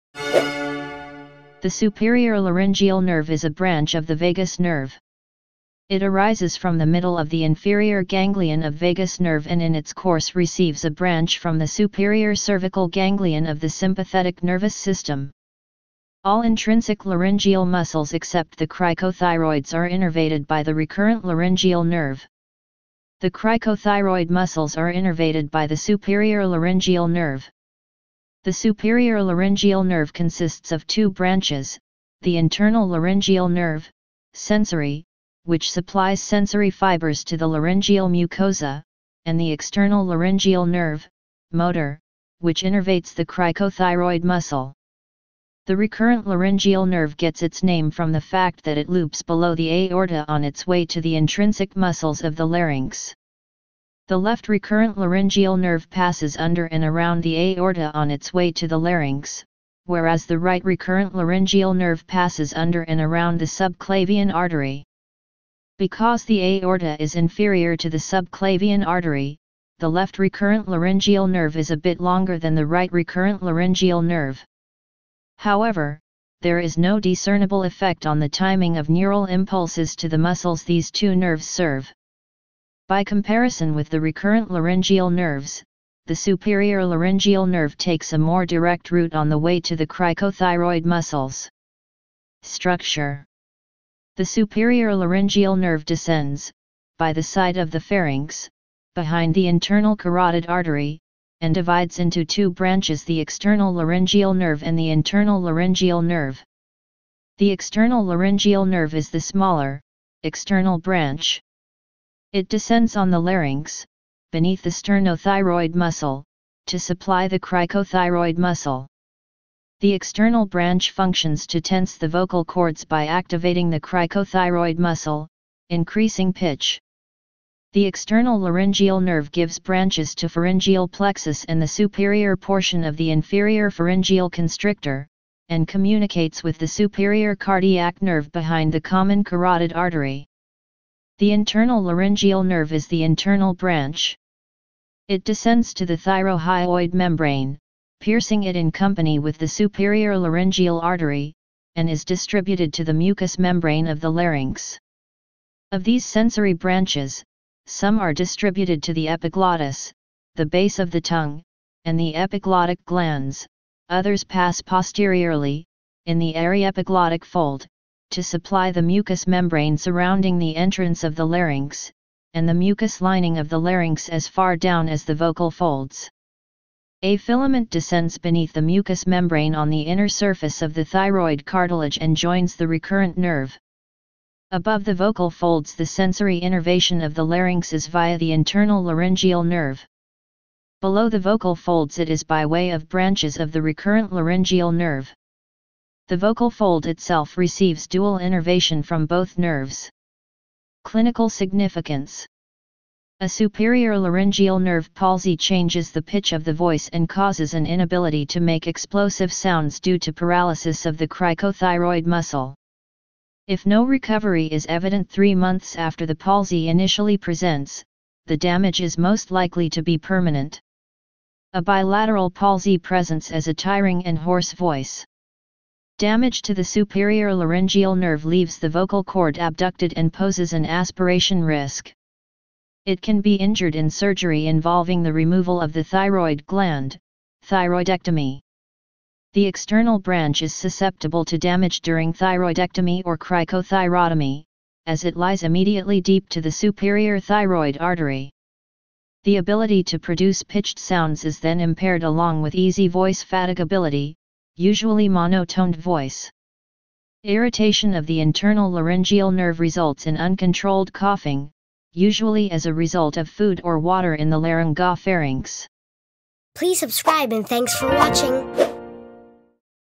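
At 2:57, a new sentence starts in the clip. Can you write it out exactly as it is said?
A filament descends beneath the mucous membrane on the inner surface of the thyroid cartilage and joins the recurrent nerve.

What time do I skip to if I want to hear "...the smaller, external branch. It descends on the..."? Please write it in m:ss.
1:49.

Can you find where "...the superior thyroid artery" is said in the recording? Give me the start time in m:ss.
4:06.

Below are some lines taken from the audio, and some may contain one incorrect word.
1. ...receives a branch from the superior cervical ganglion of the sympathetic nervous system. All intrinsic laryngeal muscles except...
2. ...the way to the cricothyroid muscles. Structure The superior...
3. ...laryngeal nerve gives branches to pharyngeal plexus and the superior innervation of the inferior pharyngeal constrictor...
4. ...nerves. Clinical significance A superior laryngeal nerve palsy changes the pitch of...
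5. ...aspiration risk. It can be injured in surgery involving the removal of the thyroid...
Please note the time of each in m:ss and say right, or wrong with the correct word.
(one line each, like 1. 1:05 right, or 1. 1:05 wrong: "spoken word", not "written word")
1. 0:10 right
2. 1:29 right
3. 2:08 wrong: "portion", not "innervation"
4. 3:19 right
5. 3:50 right.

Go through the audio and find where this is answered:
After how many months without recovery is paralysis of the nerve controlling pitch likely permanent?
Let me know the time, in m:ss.
3:35.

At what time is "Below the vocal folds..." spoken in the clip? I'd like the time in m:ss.
3:10.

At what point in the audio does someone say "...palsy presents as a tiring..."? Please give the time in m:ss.
3:42.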